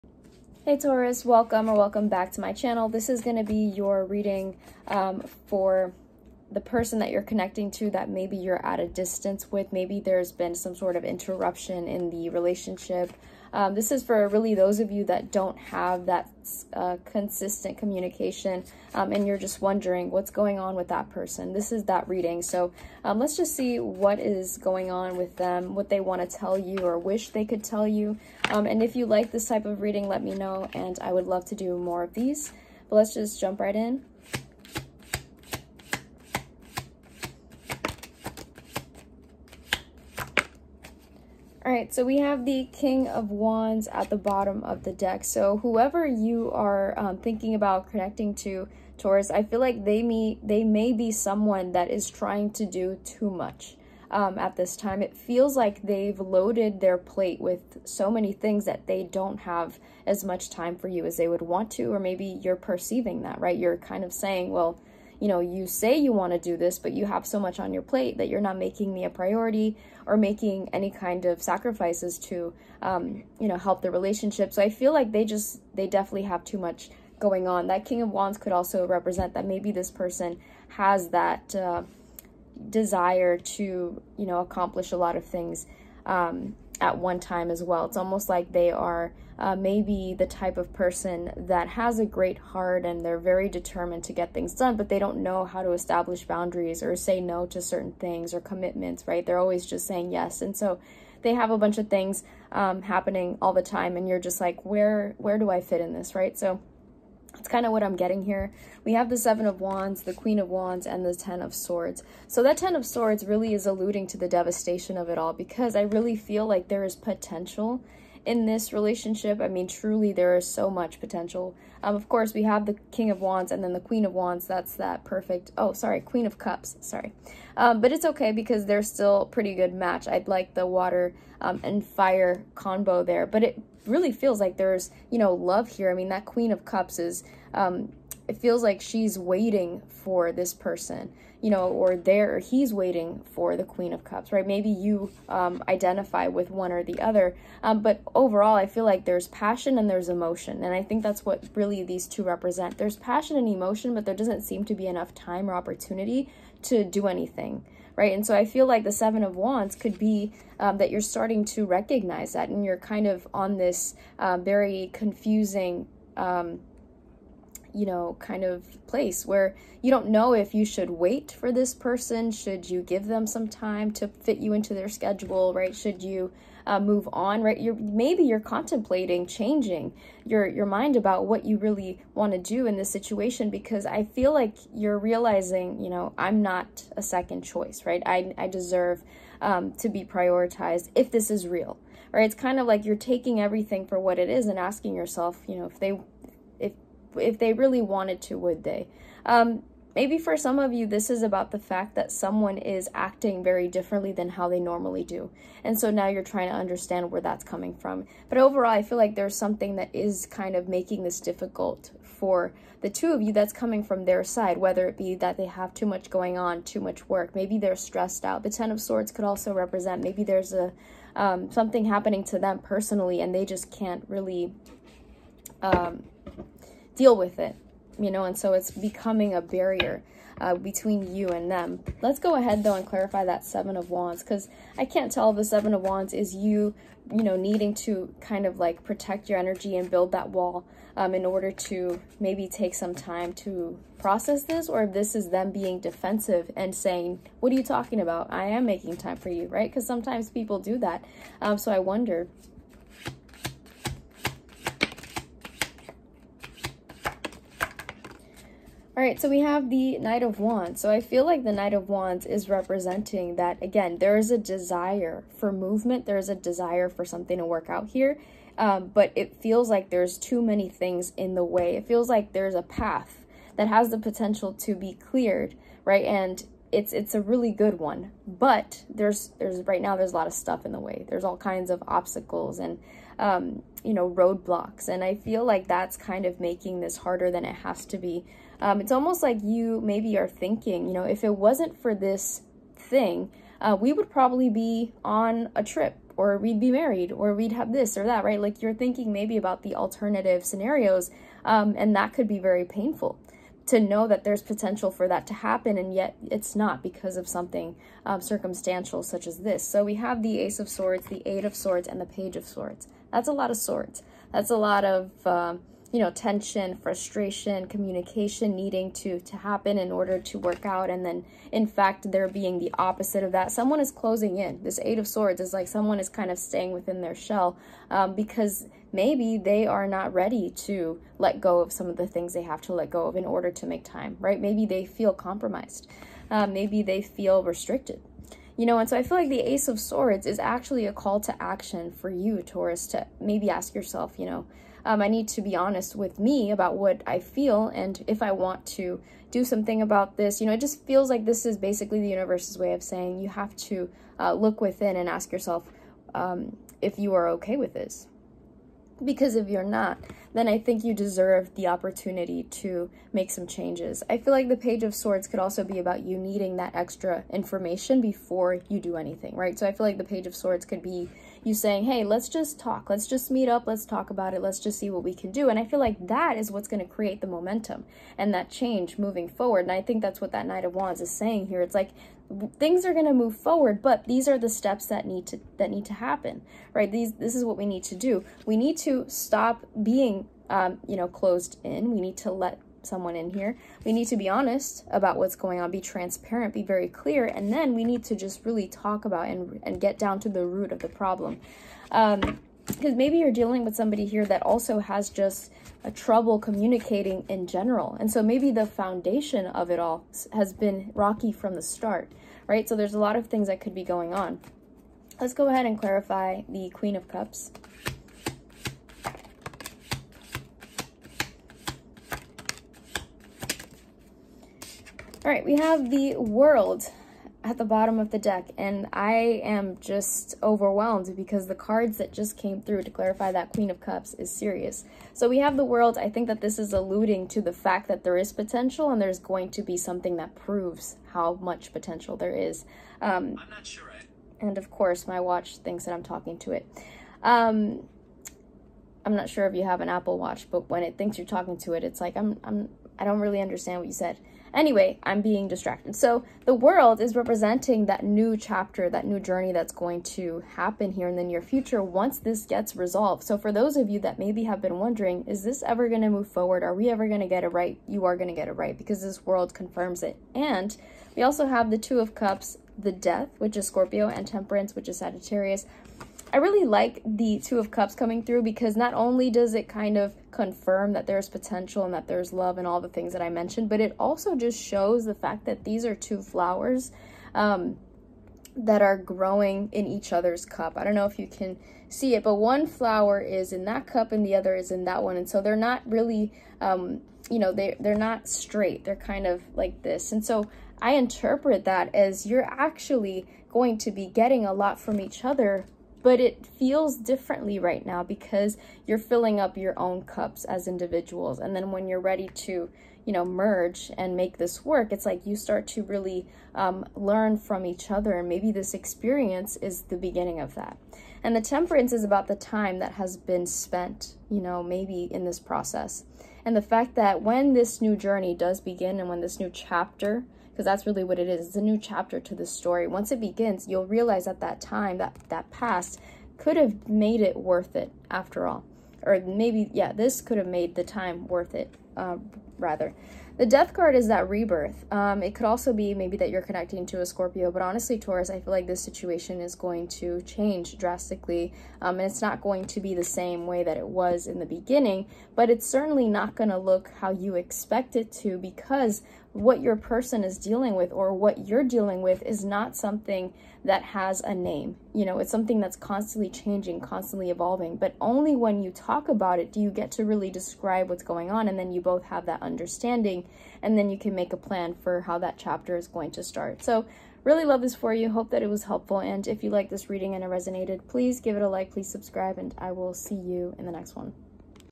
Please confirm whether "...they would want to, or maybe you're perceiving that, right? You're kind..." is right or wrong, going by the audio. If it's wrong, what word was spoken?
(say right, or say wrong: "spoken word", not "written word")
right.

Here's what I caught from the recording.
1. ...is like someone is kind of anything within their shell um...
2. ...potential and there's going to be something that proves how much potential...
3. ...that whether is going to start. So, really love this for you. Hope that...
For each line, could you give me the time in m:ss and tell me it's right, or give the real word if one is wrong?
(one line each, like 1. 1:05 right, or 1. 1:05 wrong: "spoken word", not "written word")
1. 5:25 wrong: "staying", not "anything"
2. 7:18 right
3. 9:35 wrong: "chapter", not "whether".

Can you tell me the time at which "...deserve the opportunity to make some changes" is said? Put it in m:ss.
6:00.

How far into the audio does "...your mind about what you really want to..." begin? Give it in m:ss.
3:00.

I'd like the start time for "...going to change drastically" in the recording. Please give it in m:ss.
9:09.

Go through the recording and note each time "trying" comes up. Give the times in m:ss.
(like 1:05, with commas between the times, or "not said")
0:52, 3:26.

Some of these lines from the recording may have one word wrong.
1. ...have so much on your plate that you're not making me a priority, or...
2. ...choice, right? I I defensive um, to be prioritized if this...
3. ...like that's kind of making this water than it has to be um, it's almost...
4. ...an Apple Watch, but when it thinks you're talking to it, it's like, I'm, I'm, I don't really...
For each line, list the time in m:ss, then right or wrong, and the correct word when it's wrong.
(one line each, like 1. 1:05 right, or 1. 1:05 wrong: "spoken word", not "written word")
1. 1:07 right
2. 3:07 wrong: "deserve", not "defensive"
3. 4:45 wrong: "harder", not "water"
4. 7:29 right.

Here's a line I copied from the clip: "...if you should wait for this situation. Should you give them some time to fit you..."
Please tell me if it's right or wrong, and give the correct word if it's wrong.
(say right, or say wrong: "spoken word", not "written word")
wrong: "person", not "situation".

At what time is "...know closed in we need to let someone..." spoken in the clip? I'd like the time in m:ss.
6:30.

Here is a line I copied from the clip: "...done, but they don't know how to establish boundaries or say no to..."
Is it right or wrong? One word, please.
right.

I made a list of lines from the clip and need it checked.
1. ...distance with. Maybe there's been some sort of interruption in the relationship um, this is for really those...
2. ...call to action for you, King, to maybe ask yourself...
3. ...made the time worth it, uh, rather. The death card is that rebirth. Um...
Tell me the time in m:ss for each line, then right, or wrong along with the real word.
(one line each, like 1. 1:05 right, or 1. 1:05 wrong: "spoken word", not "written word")
1. 0:08 right
2. 5:40 wrong: "Taurus", not "King"
3. 9:00 right.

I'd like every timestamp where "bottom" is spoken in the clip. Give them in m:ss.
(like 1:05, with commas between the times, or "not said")
0:44, 7:07.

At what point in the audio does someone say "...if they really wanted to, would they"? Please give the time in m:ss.
3:17.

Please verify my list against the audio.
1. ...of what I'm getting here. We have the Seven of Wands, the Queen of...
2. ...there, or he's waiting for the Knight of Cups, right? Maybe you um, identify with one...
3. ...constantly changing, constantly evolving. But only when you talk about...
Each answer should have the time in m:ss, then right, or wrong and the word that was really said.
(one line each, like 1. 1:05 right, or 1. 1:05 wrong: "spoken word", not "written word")
1. 1:47 right
2. 2:21 wrong: "Queen", not "Knight"
3. 9:25 right.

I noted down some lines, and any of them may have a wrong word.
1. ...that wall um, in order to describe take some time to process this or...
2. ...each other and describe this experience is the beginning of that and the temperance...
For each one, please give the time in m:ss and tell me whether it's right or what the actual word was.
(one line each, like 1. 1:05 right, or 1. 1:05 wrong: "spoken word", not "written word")
1. 4:00 wrong: "maybe", not "describe"
2. 8:37 wrong: "maybe", not "describe".